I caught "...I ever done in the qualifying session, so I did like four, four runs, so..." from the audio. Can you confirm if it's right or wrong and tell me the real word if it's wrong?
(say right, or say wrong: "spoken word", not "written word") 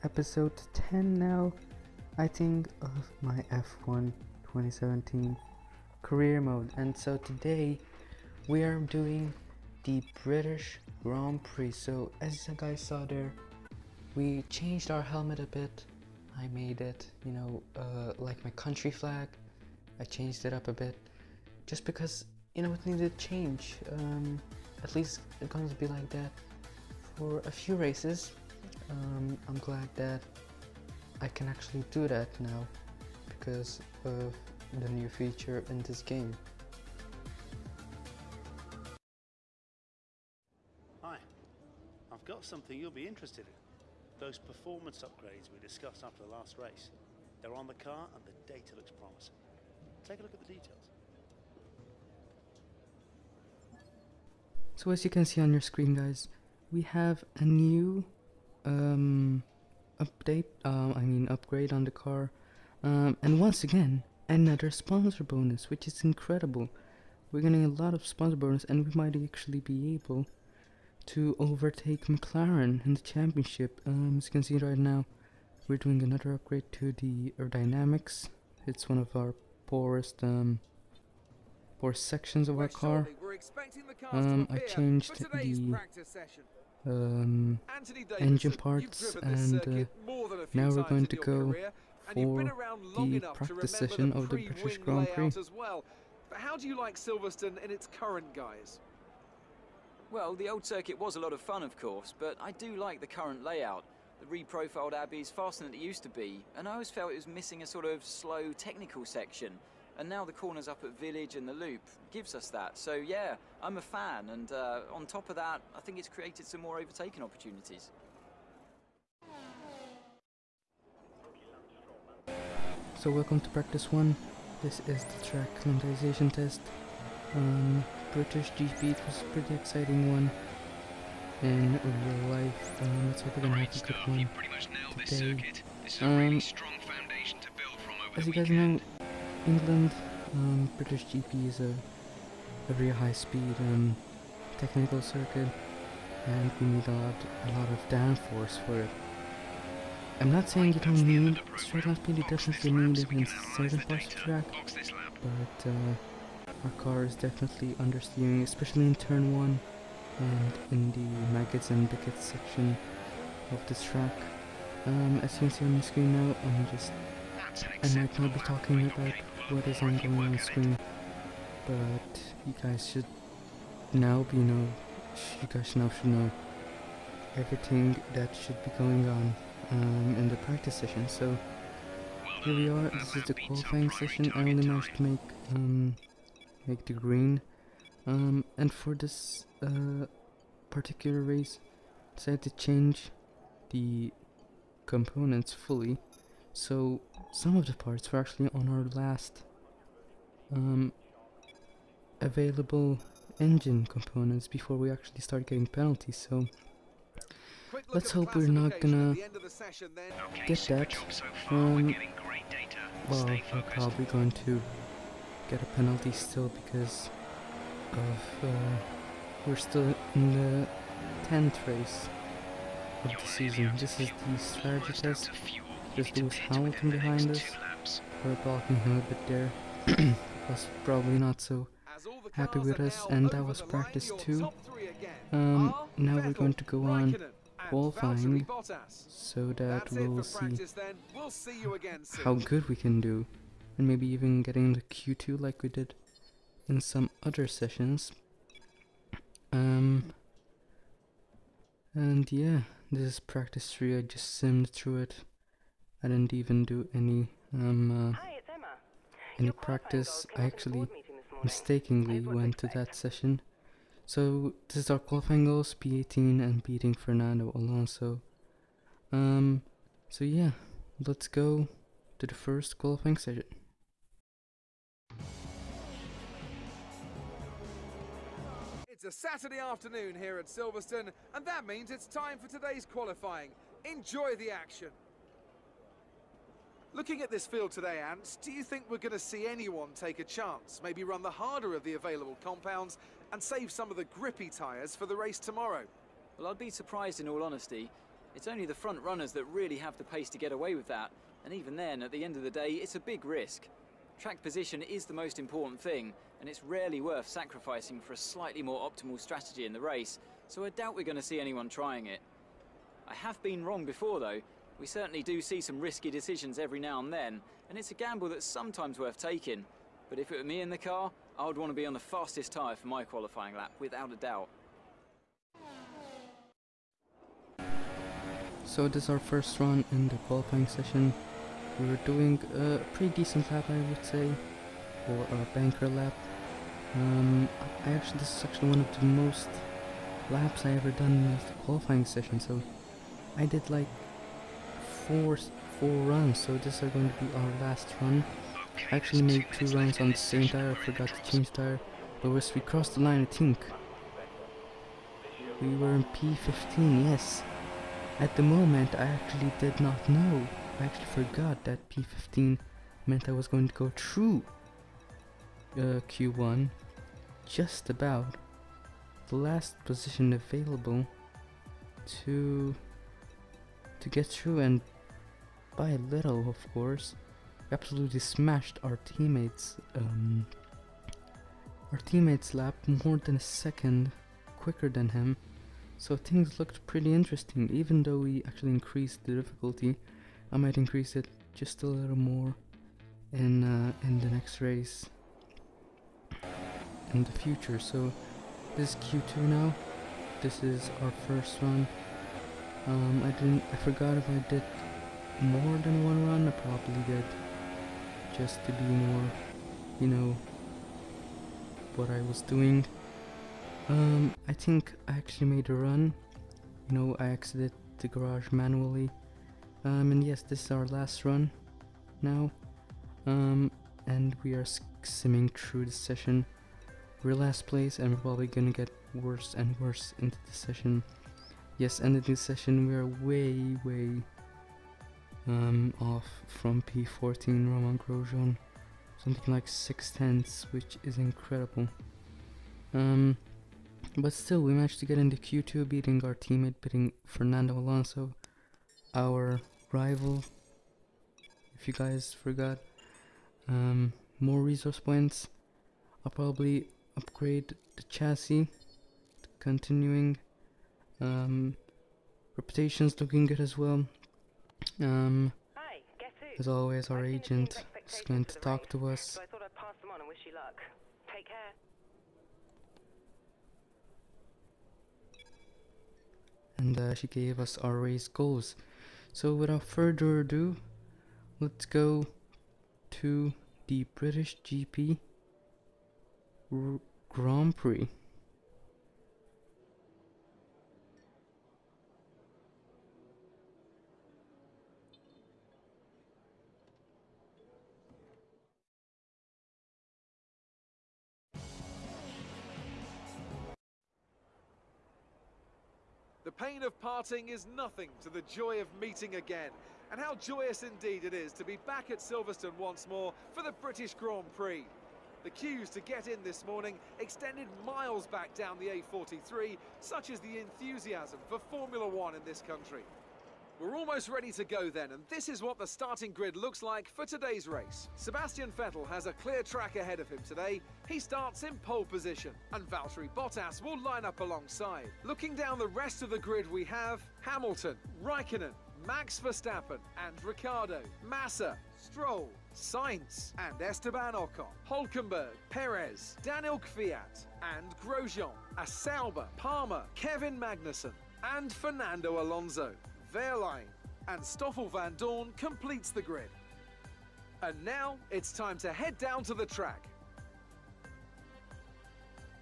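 right.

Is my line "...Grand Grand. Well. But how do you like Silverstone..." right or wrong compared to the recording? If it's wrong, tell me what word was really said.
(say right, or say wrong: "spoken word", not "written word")
wrong: "Prix", not "Grand".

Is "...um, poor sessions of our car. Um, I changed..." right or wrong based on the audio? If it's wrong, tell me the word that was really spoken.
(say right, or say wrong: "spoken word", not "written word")
wrong: "sections", not "sessions".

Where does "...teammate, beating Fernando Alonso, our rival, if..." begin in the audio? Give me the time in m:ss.
7:26.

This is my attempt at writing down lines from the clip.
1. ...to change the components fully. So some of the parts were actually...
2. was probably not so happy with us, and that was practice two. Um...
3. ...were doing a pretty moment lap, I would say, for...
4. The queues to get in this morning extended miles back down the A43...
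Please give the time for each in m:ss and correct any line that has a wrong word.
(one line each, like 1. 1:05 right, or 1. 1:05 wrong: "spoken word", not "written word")
1. 3:12 right
2. 3:50 right
3. 5:31 wrong: "decent", not "moment"
4. 8:35 right.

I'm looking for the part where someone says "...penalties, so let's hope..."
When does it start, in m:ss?
3:25.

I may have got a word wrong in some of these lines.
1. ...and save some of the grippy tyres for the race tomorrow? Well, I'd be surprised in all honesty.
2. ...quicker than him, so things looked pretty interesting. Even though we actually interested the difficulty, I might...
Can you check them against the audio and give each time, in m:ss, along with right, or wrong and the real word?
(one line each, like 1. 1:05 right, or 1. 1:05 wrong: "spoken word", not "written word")
1. 4:53 right
2. 6:24 wrong: "increased", not "interested".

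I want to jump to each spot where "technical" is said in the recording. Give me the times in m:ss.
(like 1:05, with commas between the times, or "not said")
1:48, 2:24.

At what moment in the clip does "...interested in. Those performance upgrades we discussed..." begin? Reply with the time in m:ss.
0:43.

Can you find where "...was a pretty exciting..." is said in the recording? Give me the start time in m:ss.
2:09.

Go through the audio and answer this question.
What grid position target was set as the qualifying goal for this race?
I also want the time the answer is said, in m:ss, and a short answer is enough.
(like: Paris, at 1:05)
P18, at 4:25.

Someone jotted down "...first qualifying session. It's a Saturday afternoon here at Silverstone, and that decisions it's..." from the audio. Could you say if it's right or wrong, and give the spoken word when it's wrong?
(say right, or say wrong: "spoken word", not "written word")
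wrong: "means", not "decisions".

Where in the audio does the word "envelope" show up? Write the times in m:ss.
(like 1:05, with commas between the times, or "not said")
not said.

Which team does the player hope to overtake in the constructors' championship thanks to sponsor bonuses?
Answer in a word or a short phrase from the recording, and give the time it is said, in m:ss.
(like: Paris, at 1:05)
McLaren, at 1:12.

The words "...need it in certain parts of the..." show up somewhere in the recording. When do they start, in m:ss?
2:32.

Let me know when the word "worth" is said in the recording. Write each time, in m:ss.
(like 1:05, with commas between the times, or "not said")
5:07, 5:18.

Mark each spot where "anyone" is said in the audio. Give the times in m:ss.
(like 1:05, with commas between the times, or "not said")
4:49, 5:11.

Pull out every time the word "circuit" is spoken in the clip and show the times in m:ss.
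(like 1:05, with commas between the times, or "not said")
1:40, 2:25.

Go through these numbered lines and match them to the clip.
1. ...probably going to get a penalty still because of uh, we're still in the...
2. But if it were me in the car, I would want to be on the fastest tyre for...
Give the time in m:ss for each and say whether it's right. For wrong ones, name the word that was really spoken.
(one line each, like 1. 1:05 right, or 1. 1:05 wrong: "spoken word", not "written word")
1. 3:33 right
2. 5:20 right.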